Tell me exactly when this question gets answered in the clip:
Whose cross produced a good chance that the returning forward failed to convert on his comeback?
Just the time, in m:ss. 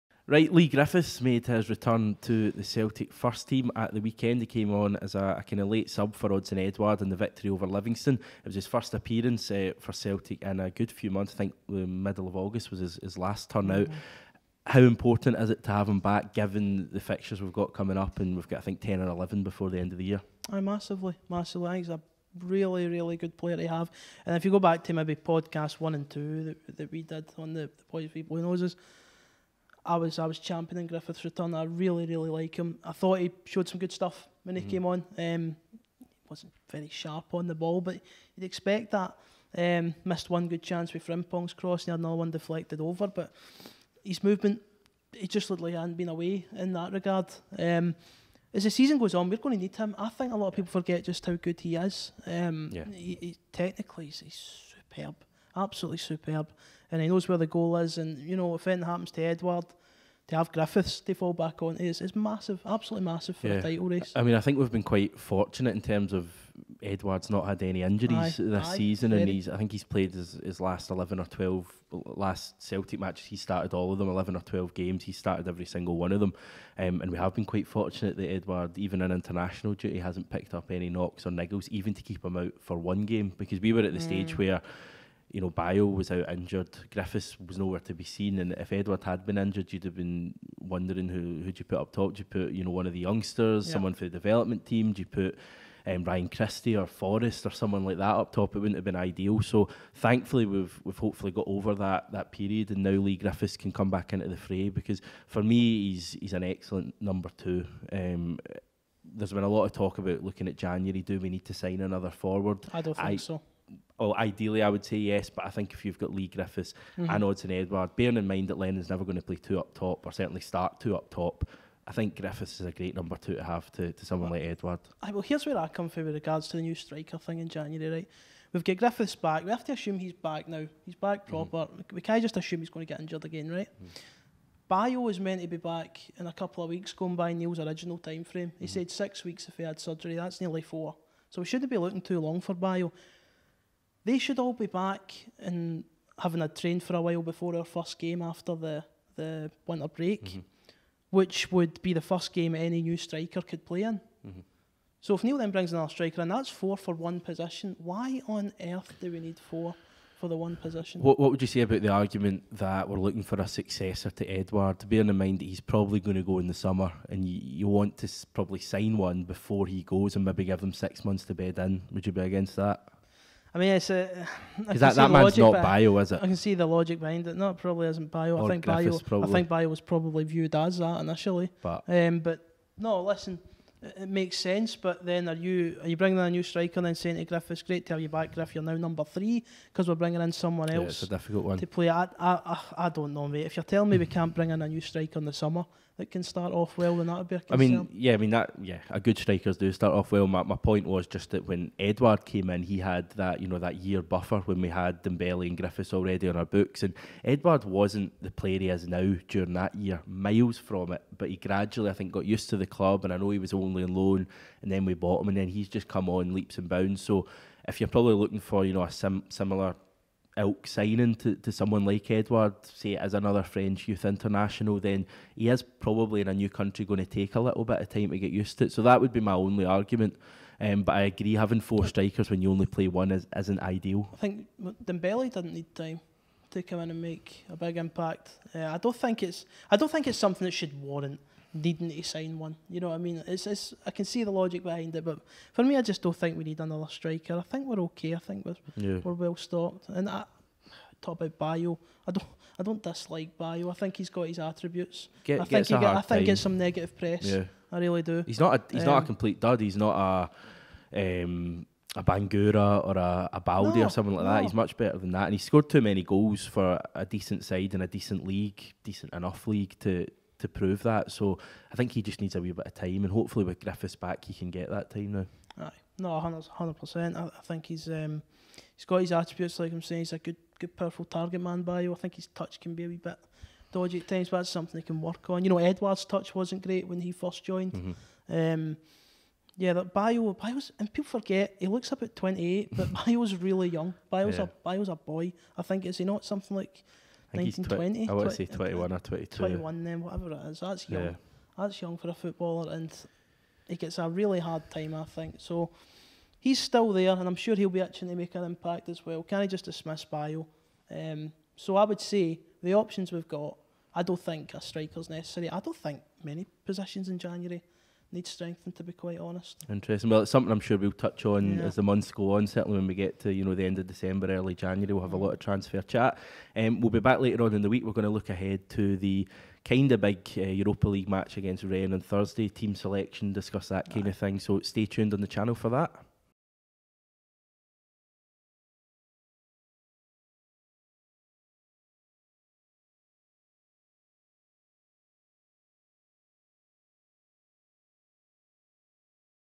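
0:41.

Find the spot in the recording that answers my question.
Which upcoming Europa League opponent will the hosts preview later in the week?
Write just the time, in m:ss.
5:31.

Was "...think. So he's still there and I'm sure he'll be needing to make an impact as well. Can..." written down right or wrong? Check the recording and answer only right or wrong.
wrong.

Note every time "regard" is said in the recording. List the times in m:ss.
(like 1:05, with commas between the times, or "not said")
0:46, 2:06.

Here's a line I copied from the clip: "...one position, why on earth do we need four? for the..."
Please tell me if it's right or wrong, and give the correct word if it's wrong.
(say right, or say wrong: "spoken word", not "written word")
right.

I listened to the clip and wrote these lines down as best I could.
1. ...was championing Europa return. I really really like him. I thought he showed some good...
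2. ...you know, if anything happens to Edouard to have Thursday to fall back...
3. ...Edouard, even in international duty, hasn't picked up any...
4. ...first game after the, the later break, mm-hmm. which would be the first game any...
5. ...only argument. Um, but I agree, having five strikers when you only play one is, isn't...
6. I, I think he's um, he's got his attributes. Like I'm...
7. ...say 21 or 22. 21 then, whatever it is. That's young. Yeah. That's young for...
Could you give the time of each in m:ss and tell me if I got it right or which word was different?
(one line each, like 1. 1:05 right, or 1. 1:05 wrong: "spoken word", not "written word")
1. 0:30 wrong: "Griffiths", not "Europa"
2. 0:58 wrong: "Griffiths", not "Thursday"
3. 1:18 right
4. 2:27 wrong: "winter", not "later"
5. 3:49 wrong: "four", not "five"
6. 4:37 right
7. 4:58 right.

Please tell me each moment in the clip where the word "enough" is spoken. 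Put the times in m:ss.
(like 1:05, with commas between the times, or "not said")
4:29.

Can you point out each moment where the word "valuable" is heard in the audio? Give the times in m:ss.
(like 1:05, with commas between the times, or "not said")
not said.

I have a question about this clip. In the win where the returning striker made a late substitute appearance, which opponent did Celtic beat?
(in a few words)
Livingston.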